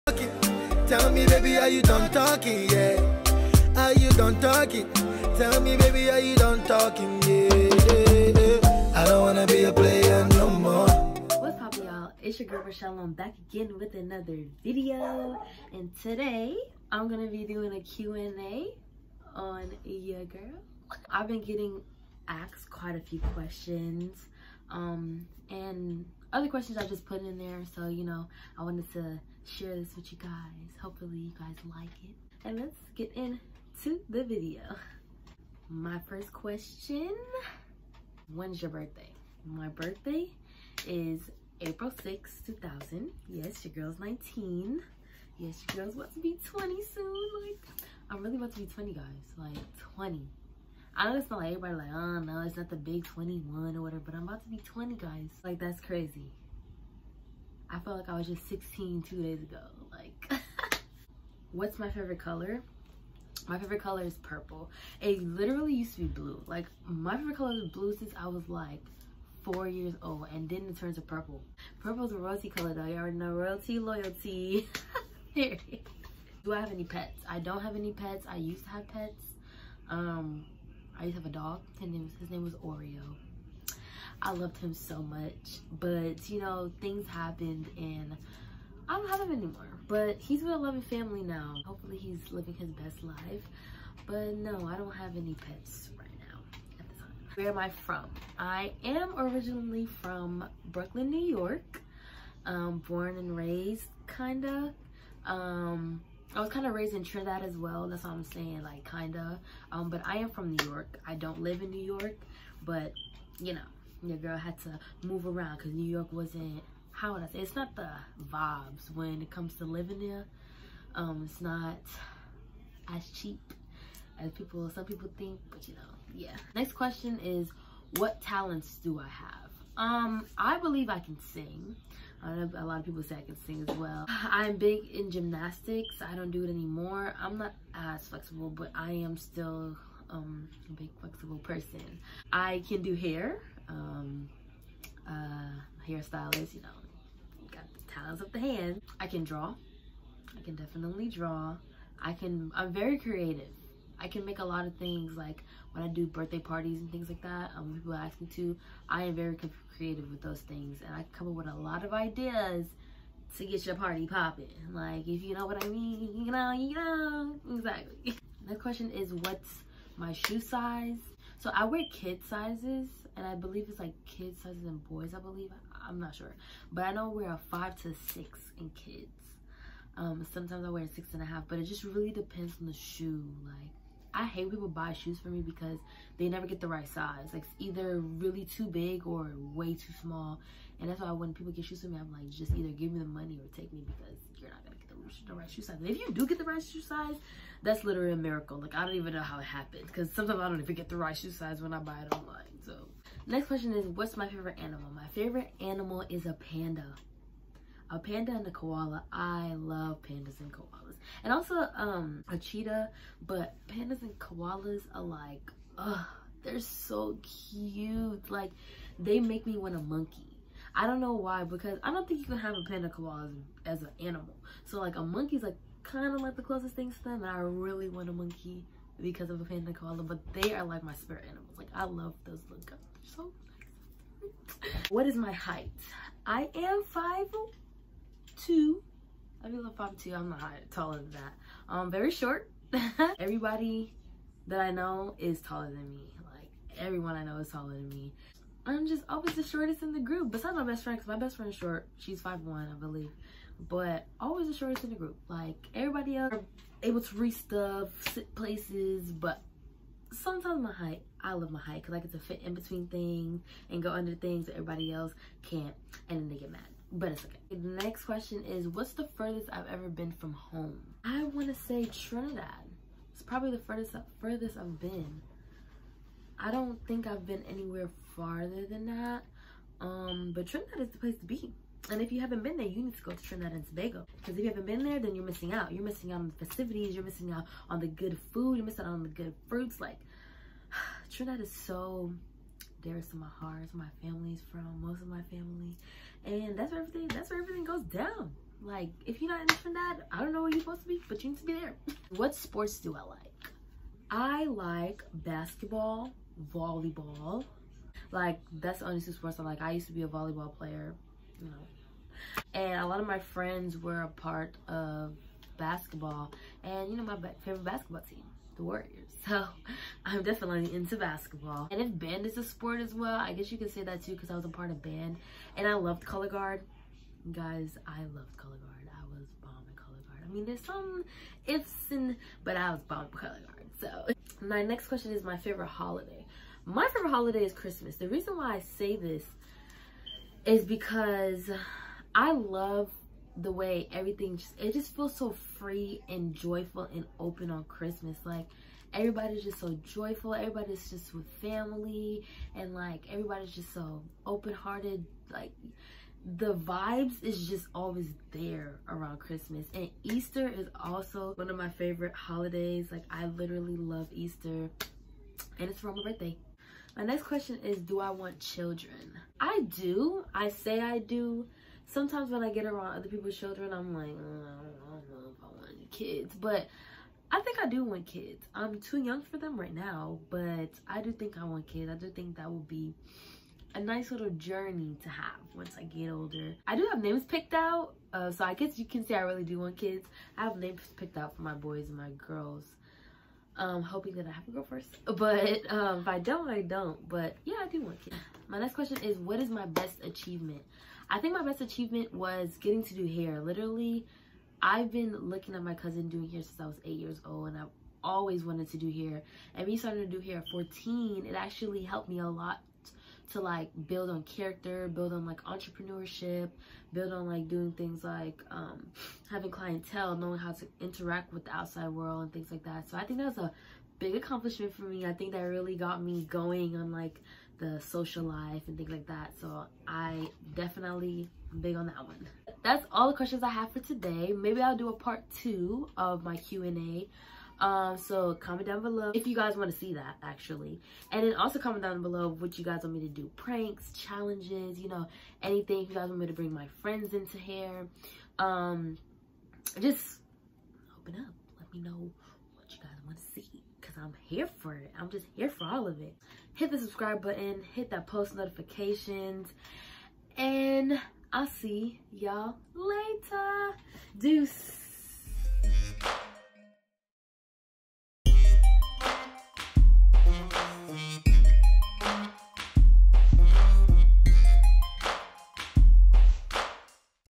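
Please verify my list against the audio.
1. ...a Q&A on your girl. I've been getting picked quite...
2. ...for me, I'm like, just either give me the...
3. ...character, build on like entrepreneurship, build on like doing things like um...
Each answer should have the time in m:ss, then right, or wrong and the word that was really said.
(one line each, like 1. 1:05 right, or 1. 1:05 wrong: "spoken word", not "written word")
1. 0:17 wrong: "asked", not "picked"
2. 3:11 right
3. 6:54 right.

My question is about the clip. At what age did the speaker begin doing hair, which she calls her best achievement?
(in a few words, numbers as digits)
14.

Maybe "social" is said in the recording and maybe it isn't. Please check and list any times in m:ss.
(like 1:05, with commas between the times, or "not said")
7:07.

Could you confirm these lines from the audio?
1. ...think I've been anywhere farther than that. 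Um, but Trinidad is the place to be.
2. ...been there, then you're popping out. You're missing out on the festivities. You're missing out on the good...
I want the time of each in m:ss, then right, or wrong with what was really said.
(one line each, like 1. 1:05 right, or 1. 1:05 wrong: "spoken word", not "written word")
1. 4:36 right
2. 4:44 wrong: "missing", not "popping".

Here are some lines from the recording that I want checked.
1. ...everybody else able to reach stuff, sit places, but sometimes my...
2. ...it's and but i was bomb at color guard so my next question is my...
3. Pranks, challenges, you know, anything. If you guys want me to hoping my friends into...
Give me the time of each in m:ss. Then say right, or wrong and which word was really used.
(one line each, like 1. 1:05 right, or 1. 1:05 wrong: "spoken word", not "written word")
1. 4:15 right
2. 5:31 right
3. 7:23 wrong: "bring", not "hoping".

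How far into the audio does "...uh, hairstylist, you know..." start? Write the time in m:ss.
2:25.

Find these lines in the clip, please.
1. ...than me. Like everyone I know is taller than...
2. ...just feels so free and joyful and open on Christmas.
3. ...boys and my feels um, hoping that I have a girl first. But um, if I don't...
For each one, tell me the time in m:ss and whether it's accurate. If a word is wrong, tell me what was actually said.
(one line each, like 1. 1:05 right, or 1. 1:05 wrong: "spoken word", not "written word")
1. 4:05 right
2. 5:44 right
3. 6:31 wrong: "girls", not "feels".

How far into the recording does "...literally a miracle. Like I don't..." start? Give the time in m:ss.
3:17.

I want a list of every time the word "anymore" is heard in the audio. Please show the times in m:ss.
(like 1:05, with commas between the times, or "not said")
1:29, 2:16.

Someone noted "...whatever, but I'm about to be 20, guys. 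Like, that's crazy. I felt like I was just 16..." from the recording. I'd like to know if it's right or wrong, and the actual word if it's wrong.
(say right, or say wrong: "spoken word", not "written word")
right.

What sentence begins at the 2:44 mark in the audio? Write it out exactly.
Like, if you know what I mean, you know, you know, exactly.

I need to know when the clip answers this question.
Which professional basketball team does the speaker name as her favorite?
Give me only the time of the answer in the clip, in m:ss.
5:18.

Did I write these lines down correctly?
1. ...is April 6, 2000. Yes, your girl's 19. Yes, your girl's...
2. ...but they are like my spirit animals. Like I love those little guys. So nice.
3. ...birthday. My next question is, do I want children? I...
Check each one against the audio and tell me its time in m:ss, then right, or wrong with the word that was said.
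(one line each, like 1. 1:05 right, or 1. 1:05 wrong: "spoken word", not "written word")
1. 0:40 right
2. 3:50 right
3. 6:06 right.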